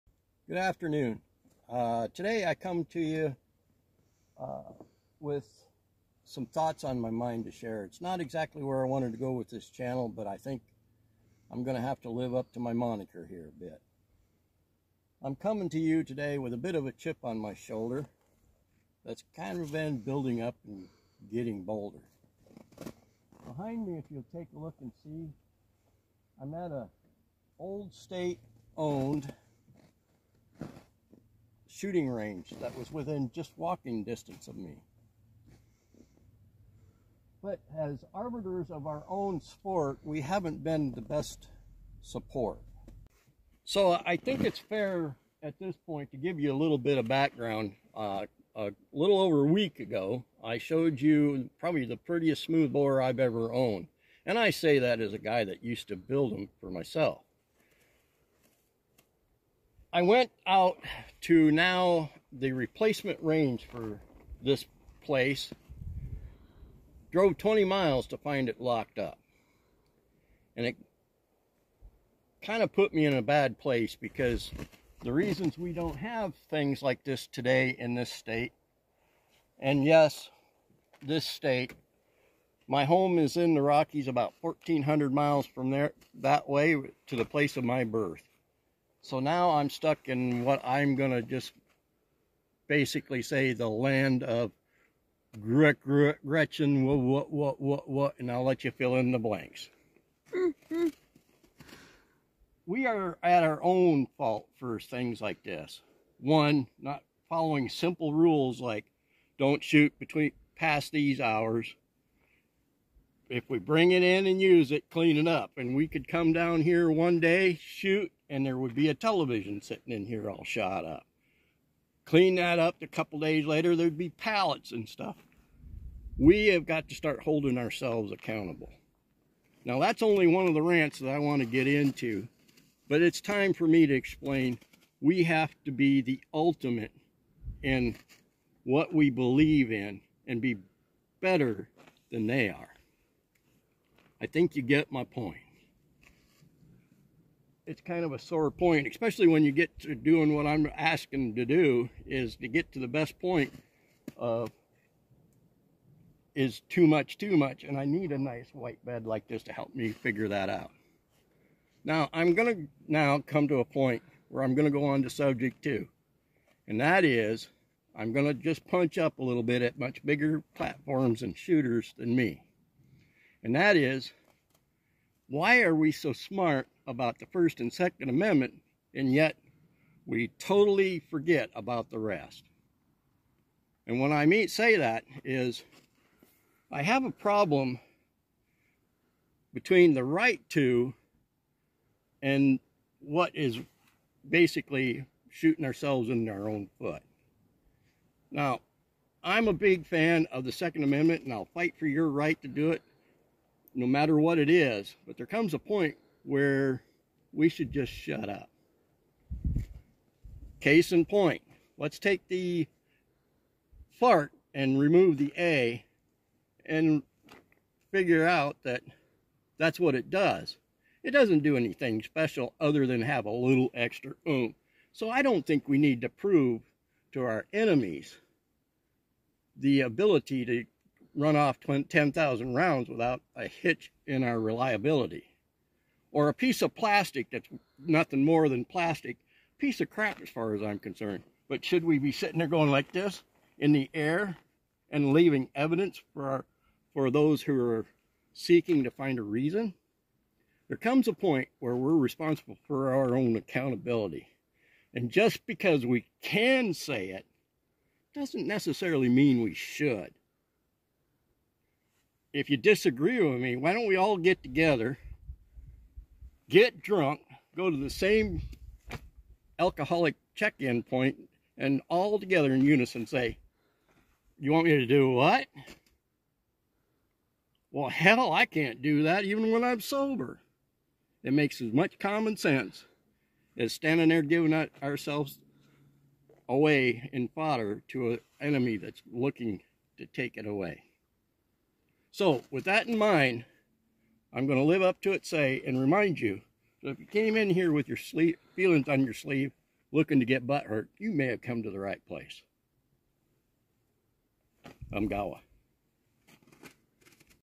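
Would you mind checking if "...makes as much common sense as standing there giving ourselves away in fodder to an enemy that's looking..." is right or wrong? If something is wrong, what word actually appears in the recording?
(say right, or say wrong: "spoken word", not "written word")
right.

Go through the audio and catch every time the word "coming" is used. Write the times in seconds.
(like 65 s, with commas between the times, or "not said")
15 s.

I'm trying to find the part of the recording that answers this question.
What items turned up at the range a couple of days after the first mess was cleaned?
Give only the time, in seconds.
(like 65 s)
124 s.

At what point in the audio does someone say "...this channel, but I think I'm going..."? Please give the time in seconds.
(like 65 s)
9 s.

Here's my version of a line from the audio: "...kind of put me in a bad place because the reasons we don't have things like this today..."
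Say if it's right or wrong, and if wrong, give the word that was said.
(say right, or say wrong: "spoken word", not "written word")
right.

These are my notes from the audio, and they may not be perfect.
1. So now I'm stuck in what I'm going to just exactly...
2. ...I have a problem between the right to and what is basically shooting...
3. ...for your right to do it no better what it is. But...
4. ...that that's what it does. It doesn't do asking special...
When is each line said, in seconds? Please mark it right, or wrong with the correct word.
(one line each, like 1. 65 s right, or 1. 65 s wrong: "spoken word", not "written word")
1. 89 s wrong: "basically", not "exactly"
2. 186 s right
3. 201 s wrong: "matter", not "better"
4. 218 s wrong: "anything", not "asking".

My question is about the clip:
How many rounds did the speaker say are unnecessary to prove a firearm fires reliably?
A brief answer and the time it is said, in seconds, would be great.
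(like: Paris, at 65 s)
10,000, at 231 s.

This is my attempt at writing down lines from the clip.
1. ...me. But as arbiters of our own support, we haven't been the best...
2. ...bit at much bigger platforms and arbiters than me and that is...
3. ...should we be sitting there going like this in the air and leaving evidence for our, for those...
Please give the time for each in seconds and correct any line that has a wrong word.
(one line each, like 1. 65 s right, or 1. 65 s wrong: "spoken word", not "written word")
1. 34 s wrong: "sport", not "support"
2. 169 s wrong: "shooters", not "arbiters"
3. 241 s right.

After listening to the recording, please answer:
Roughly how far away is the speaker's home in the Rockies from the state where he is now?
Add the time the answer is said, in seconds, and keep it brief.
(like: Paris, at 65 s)
1,400 miles, at 84 s.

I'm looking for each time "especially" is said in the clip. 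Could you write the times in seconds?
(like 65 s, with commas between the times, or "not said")
148 s.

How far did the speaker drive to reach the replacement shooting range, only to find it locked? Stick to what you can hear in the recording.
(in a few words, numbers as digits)
20 miles.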